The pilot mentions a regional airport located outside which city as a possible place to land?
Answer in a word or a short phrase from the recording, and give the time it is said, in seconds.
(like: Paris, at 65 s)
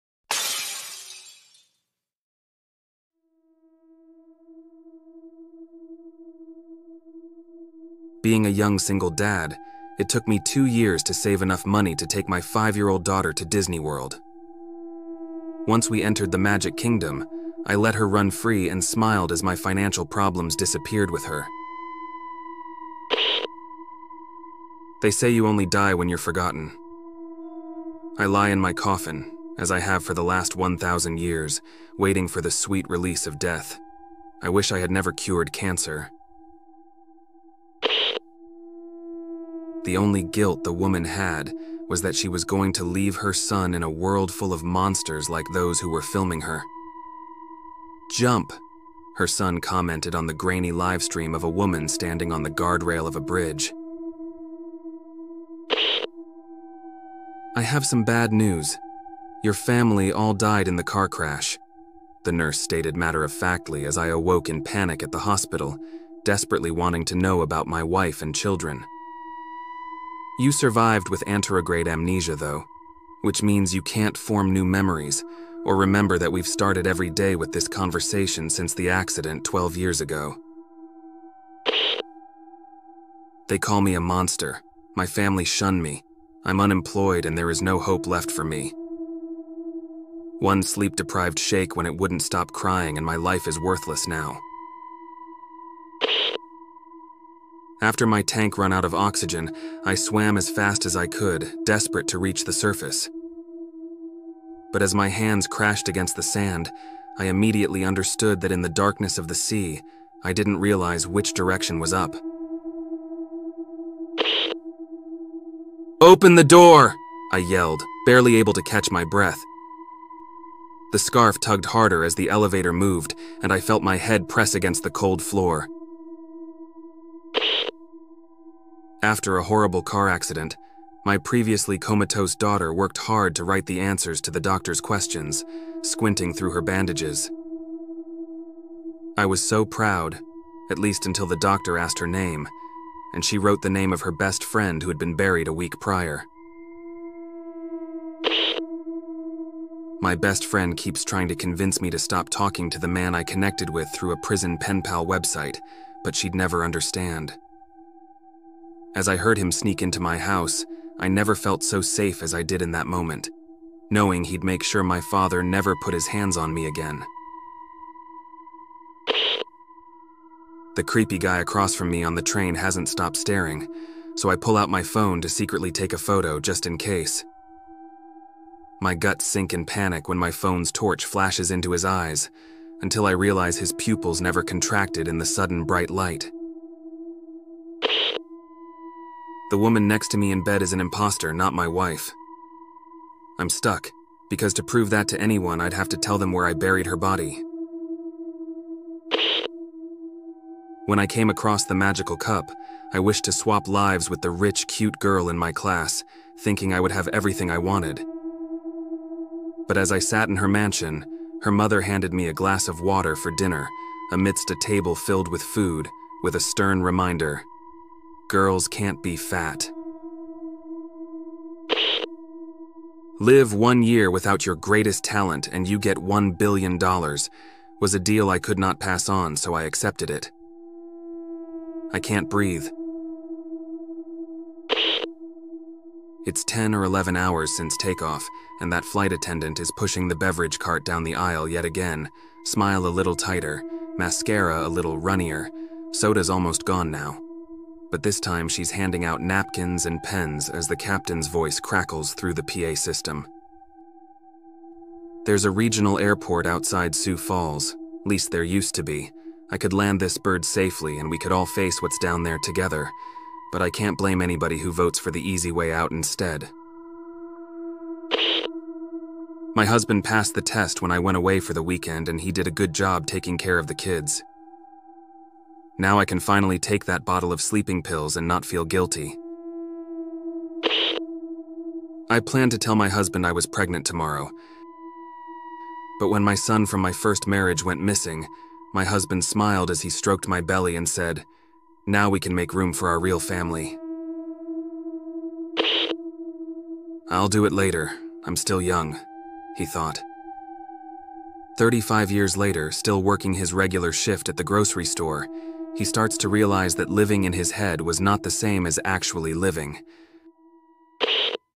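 Sioux Falls, at 256 s.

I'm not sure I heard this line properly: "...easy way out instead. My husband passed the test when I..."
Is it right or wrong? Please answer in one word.
right.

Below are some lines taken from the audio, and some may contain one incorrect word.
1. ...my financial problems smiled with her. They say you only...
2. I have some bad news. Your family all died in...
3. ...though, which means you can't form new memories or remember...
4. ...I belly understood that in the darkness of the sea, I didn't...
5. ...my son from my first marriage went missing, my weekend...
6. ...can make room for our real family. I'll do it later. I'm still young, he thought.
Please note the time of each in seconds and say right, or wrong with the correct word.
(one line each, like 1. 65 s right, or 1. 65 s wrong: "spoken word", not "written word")
1. 19 s wrong: "disappeared", not "smiled"
2. 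57 s right
3. 72 s right
4. 107 s wrong: "immediately", not "belly"
5. 286 s wrong: "husband", not "weekend"
6. 292 s right.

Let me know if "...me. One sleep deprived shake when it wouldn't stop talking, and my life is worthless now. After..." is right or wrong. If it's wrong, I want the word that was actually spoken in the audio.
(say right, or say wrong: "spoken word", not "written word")
wrong: "crying", not "talking".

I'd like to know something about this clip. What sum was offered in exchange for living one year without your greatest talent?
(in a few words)
$1 billion.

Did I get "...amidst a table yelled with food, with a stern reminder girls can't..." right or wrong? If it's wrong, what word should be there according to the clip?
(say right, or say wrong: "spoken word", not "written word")
wrong: "filled", not "yelled".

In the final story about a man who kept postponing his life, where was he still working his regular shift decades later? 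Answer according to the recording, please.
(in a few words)
grocery store.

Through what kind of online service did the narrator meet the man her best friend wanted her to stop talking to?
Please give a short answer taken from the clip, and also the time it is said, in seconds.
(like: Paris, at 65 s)
prison pen pal website, at 154 s.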